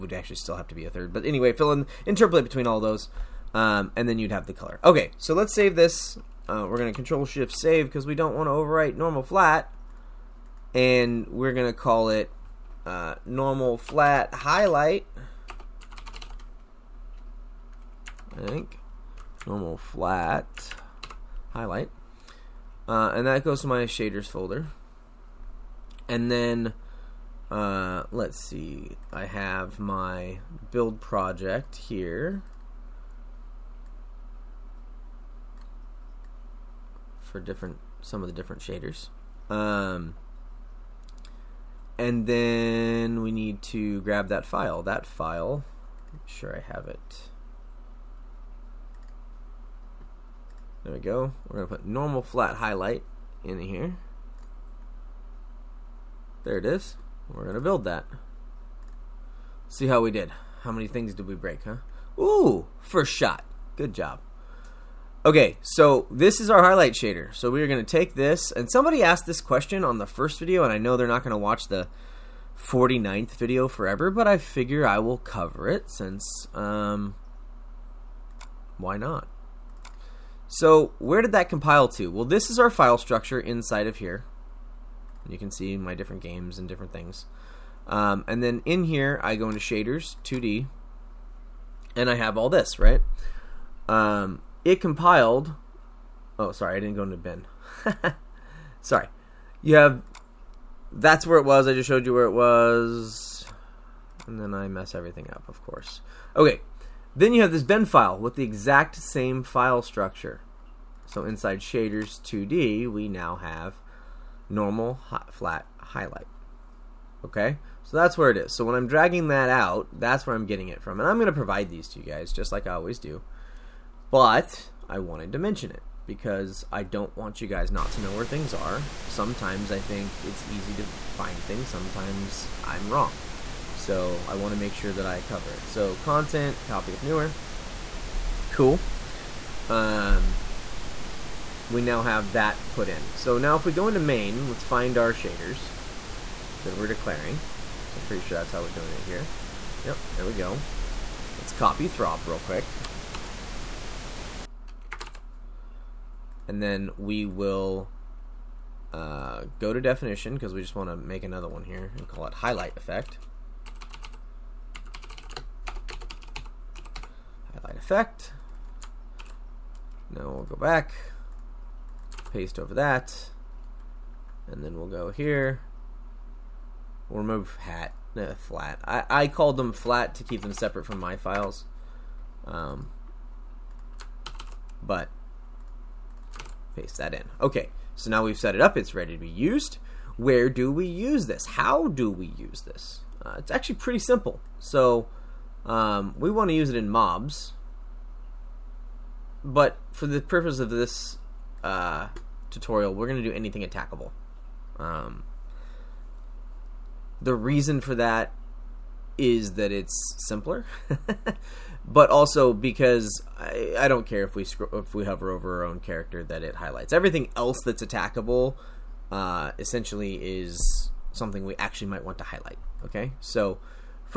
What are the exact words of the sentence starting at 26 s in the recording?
And then, uh, let's see, I have my build project here.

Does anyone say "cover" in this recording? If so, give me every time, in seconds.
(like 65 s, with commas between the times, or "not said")
75 s, 135 s.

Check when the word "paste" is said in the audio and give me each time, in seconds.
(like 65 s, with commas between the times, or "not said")
172 s, 186 s.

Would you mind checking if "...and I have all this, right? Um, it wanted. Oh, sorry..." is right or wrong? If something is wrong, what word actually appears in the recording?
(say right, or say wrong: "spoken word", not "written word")
wrong: "compiled", not "wanted".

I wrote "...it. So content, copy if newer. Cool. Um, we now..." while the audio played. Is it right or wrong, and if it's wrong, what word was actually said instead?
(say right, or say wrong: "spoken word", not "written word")
right.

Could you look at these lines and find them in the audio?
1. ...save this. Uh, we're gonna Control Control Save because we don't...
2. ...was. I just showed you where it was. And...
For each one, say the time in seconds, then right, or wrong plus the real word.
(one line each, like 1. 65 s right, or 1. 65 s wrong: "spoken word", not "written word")
1. 5 s wrong: "Shift", not "Control"
2. 101 s right.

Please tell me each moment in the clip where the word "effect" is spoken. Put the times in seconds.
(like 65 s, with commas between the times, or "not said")
162 s, 167 s.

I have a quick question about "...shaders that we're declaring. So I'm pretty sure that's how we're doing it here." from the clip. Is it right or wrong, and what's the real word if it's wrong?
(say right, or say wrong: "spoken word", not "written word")
right.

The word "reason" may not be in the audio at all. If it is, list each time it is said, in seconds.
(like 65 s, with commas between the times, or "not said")
207 s.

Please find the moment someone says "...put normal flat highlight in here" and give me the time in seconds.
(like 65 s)
51 s.